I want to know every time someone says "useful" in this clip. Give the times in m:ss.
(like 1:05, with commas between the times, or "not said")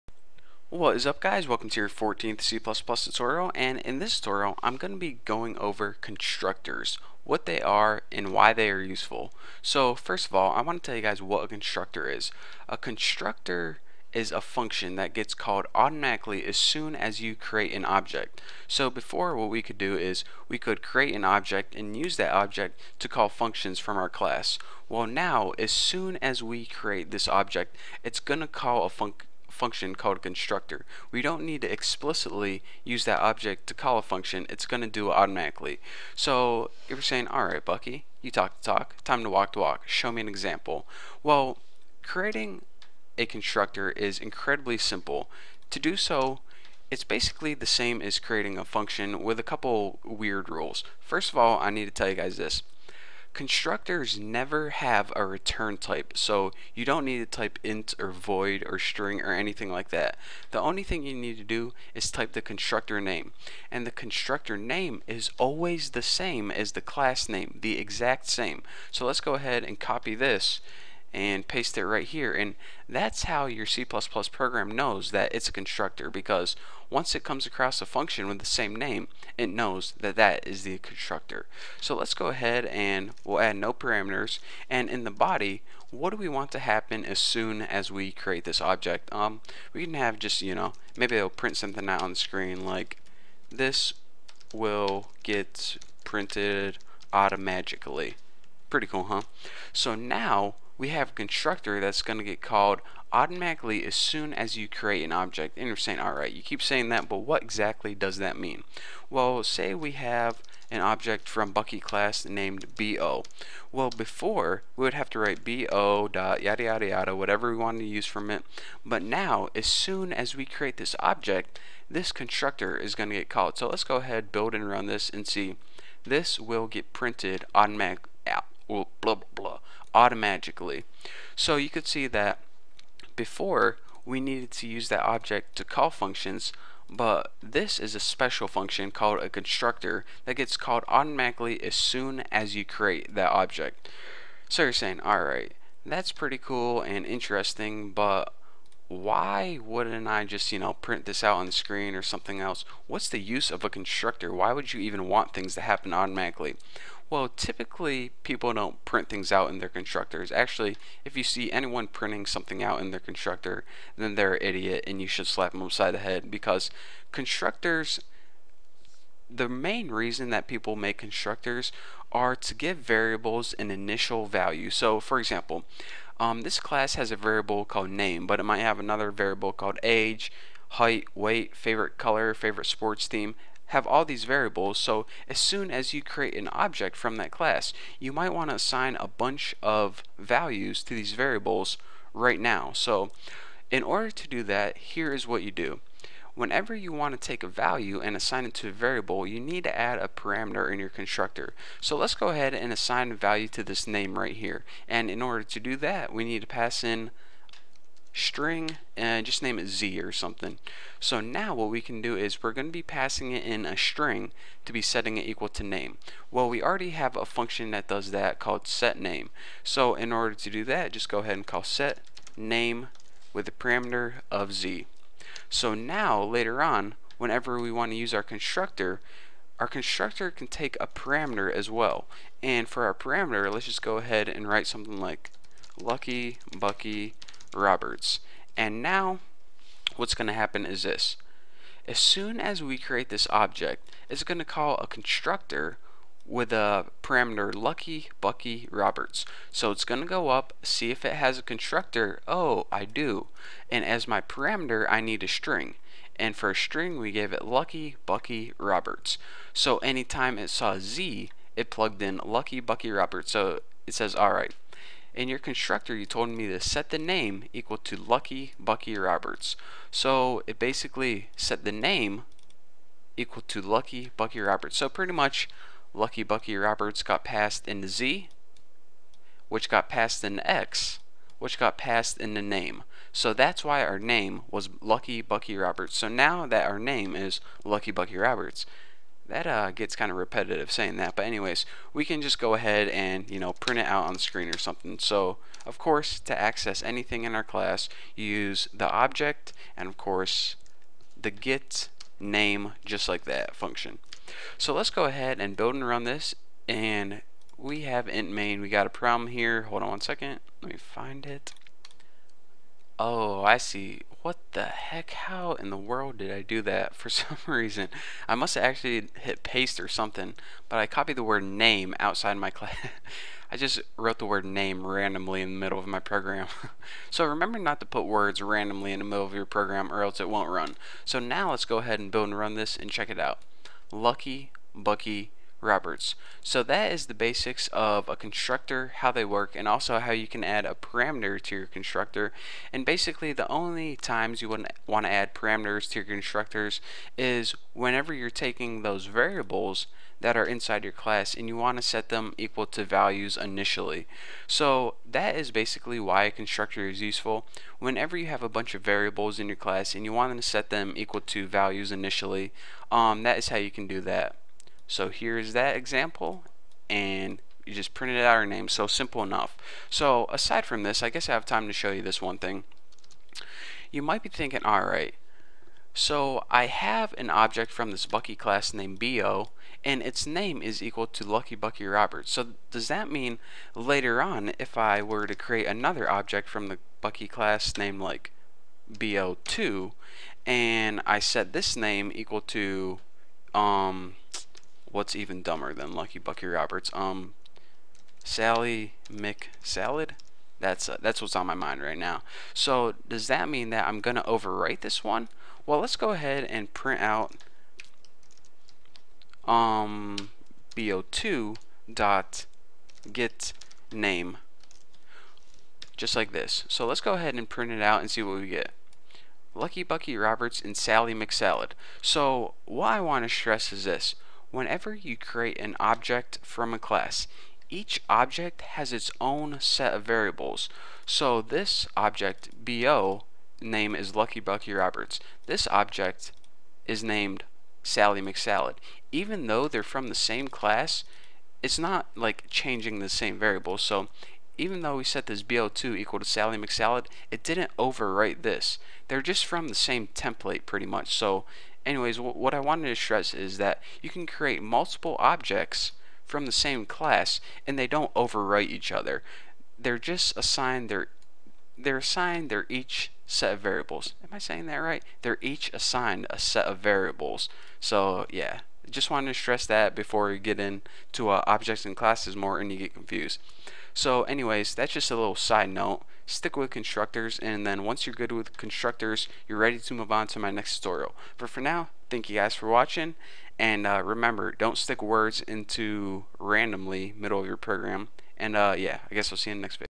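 0:08, 5:57.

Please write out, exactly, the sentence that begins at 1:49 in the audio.
Well, say we have an object from Bucky class named BO.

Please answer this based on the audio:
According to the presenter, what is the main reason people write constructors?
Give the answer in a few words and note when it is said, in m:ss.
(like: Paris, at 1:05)
To give variables an initial value, at 2:52.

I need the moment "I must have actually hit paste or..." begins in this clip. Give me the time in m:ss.
5:18.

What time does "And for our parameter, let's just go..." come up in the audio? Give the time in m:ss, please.
3:52.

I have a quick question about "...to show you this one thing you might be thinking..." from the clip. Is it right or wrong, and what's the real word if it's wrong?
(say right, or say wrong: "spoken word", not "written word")
right.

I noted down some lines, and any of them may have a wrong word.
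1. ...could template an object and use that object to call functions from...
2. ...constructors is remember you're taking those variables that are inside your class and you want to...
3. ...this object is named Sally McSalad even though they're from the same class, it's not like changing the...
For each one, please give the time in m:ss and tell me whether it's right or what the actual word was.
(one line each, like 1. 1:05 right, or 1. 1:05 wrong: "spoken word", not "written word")
1. 0:20 wrong: "create", not "template"
2. 5:46 wrong: "whenever", not "remember"
3. 7:15 right.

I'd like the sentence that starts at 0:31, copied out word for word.
We don't need to explicitly use that object to call a function.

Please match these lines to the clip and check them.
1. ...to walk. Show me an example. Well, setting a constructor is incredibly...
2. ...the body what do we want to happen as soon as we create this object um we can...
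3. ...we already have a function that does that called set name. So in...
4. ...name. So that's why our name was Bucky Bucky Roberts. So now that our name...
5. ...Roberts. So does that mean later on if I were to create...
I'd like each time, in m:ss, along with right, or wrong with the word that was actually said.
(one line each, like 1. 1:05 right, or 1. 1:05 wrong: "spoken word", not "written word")
1. 0:39 wrong: "creating", not "setting"
2. 1:25 right
3. 3:36 right
4. 4:42 wrong: "Lucky", not "Bucky"
5. 6:21 right.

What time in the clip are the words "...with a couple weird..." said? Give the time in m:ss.
0:49.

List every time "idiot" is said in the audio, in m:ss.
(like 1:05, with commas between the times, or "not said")
2:44.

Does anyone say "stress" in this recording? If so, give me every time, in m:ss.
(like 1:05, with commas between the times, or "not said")
7:03, 7:32, 7:49.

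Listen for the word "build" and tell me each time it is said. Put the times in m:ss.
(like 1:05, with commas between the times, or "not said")
2:04, 5:05, 5:32.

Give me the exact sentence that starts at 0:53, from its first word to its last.
Constructors never have a return type, so you don't need to type int or void or string or anything like that.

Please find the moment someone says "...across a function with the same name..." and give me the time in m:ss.
1:17.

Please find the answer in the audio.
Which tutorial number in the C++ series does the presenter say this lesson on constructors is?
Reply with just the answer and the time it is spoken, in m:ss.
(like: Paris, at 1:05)
14th, at 0:01.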